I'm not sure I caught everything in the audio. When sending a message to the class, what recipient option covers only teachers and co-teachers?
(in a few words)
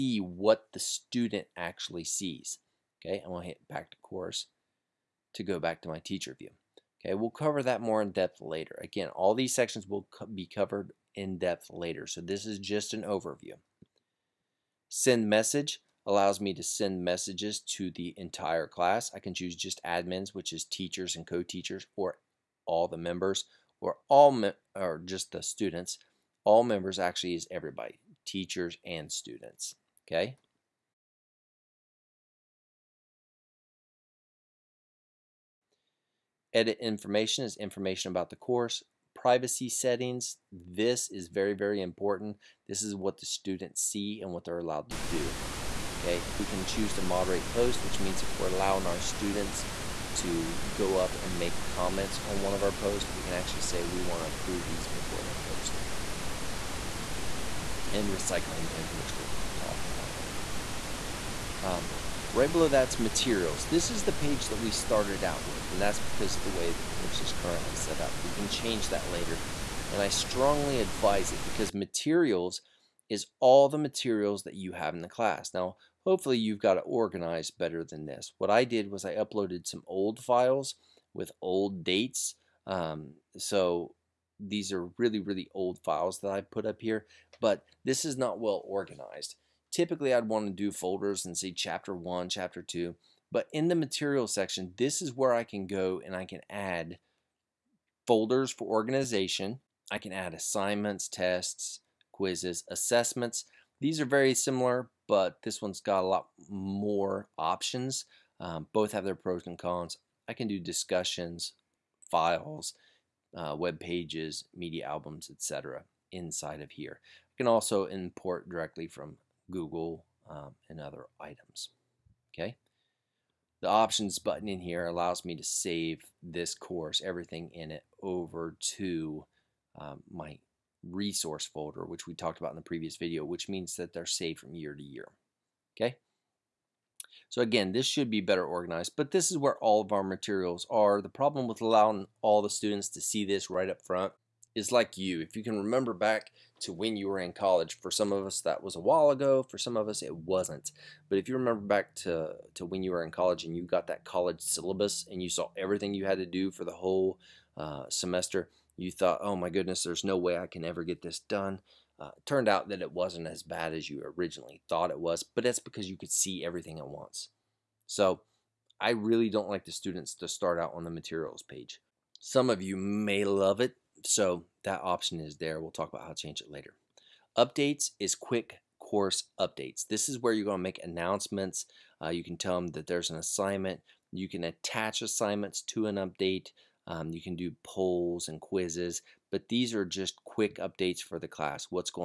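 admins.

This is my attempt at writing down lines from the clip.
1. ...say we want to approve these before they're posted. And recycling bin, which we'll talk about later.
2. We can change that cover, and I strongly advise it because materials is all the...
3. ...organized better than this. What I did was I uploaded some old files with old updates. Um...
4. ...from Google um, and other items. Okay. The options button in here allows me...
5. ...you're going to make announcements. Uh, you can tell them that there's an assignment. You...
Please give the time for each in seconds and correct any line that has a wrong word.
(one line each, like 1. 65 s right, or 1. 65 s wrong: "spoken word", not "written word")
1. 53 s right
2. 68 s wrong: "later", not "cover"
3. 76 s wrong: "dates", not "updates"
4. 118 s right
5. 180 s right.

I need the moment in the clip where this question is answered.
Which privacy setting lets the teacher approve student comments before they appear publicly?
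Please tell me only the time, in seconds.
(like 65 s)
47 s.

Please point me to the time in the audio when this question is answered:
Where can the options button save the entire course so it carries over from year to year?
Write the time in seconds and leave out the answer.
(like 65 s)
130 s.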